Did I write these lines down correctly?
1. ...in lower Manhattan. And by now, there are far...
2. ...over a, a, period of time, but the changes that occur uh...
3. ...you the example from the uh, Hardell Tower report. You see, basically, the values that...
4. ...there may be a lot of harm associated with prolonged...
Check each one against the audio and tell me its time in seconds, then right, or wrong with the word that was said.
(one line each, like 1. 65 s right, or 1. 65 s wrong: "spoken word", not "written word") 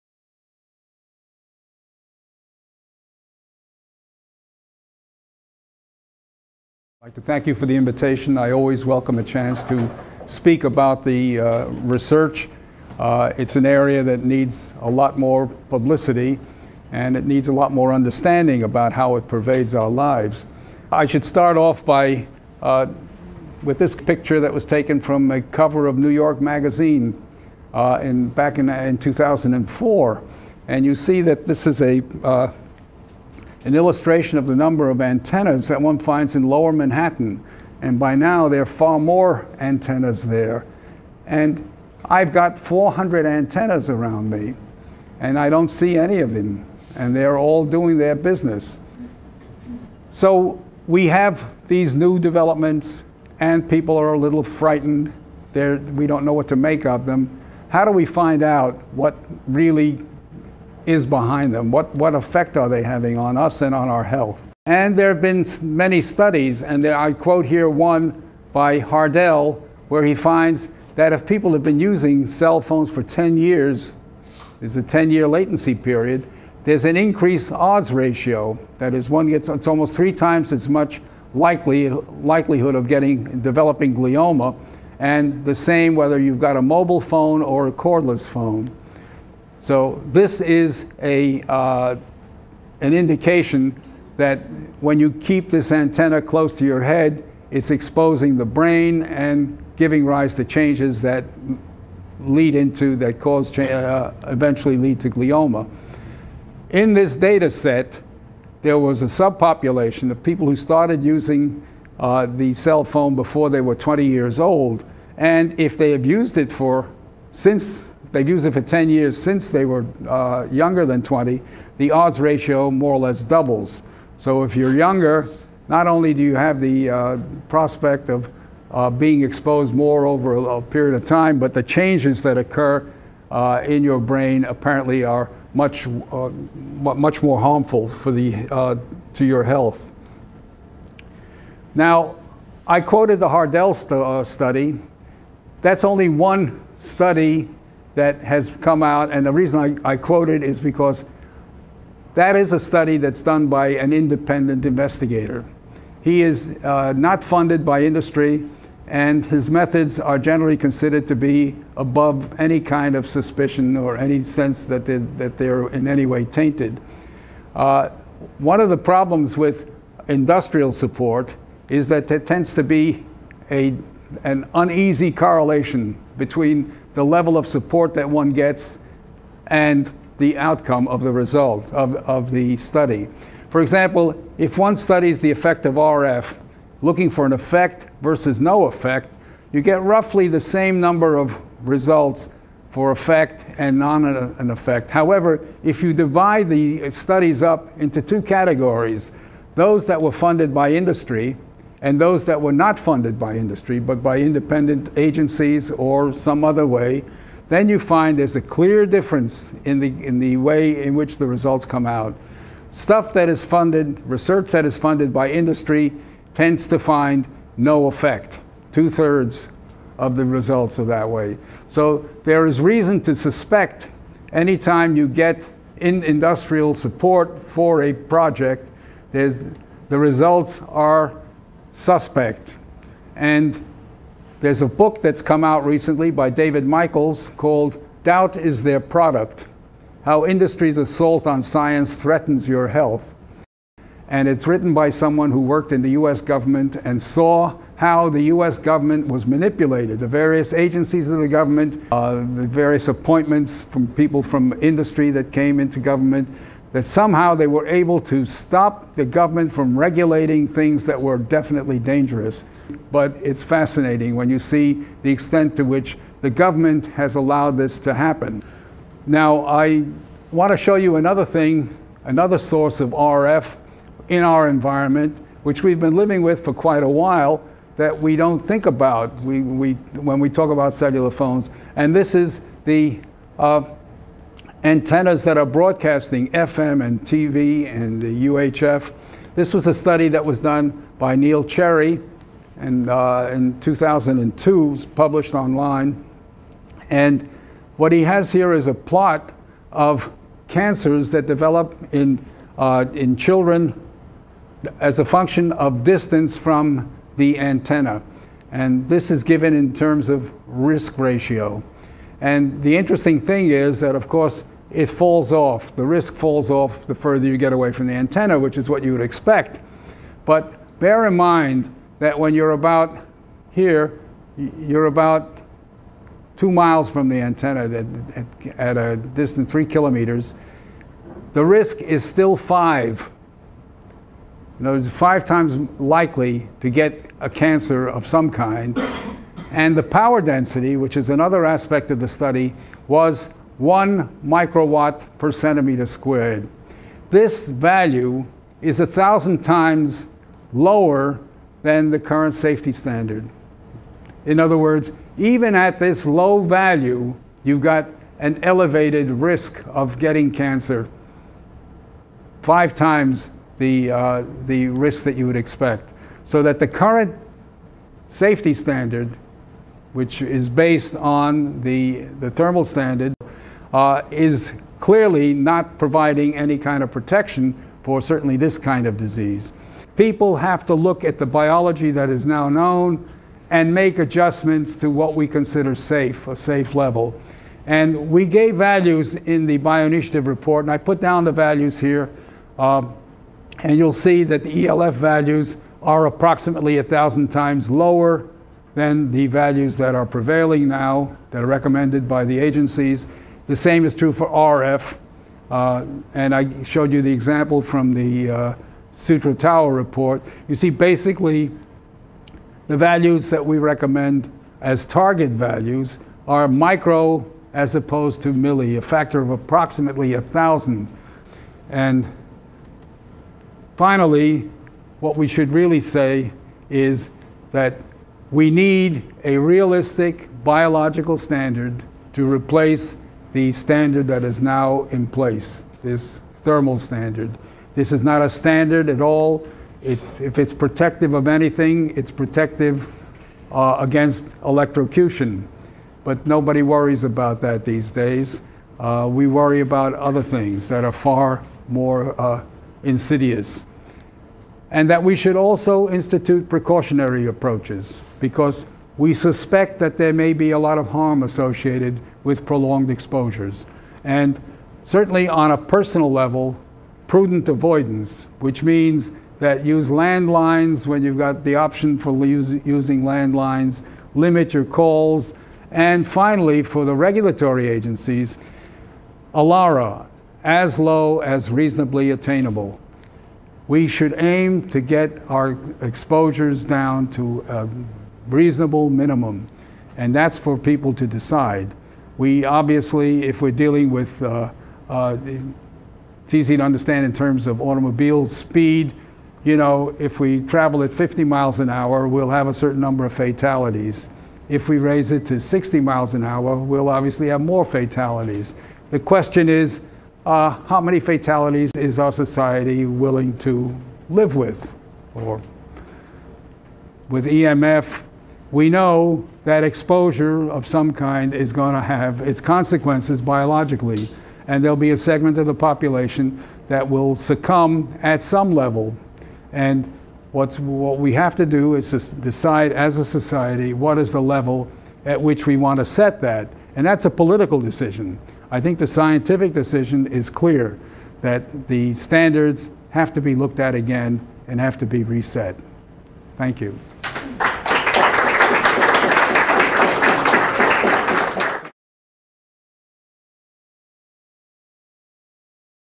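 1. 36 s right
2. 130 s right
3. 406 s wrong: "Sutro", not "Hardell"
4. 459 s right.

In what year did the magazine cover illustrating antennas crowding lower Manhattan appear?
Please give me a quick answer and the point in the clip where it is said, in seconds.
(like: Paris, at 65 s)
2004, at 28 s.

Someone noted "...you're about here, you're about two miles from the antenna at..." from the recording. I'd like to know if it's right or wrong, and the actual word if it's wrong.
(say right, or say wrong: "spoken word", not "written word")
right.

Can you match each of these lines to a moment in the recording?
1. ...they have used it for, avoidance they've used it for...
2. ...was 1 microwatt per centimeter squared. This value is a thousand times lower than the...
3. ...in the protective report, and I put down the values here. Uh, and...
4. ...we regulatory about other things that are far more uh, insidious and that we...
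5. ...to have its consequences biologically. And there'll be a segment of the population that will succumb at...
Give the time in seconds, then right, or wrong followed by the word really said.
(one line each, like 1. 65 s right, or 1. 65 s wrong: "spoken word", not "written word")
1. 115 s wrong: "since", not "avoidance"
2. 342 s right
3. 389 s wrong: "bioinitiative", not "protective"
4. 449 s wrong: "worry", not "regulatory"
5. 521 s right.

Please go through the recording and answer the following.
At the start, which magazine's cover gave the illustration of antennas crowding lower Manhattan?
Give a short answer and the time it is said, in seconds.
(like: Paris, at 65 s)
New York Magazine, at 25 s.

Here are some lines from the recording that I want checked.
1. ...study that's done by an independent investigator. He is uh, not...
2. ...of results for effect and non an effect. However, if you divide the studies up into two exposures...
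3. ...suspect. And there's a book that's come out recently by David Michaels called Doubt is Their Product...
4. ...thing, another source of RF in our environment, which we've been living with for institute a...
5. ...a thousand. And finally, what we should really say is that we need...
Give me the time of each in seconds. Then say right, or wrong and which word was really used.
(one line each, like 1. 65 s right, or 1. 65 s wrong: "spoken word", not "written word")
1. 152 s right
2. 191 s wrong: "categories", not "exposures"
3. 231 s right
4. 271 s wrong: "quite", not "institute"
5. 420 s right.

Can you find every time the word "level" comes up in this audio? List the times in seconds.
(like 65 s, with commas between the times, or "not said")
177 s, 386 s, 466 s, 528 s, 534 s.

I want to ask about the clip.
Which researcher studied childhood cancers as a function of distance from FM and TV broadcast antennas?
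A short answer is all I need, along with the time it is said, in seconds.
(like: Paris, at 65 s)
Neil Cherry, at 291 s.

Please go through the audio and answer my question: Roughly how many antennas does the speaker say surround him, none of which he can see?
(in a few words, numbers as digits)
400.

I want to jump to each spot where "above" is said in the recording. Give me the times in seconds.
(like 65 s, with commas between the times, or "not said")
161 s.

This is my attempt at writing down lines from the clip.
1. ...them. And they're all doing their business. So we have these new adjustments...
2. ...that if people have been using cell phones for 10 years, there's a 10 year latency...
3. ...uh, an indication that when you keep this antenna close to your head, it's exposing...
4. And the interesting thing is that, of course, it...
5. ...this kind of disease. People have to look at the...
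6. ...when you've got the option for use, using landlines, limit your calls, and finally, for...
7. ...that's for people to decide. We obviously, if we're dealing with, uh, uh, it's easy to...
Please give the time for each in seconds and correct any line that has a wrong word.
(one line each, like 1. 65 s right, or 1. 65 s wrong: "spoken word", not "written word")
1. 46 s wrong: "developments", not "adjustments"
2. 70 s right
3. 91 s right
4. 312 s right
5. 378 s right
6. 470 s right
7. 490 s right.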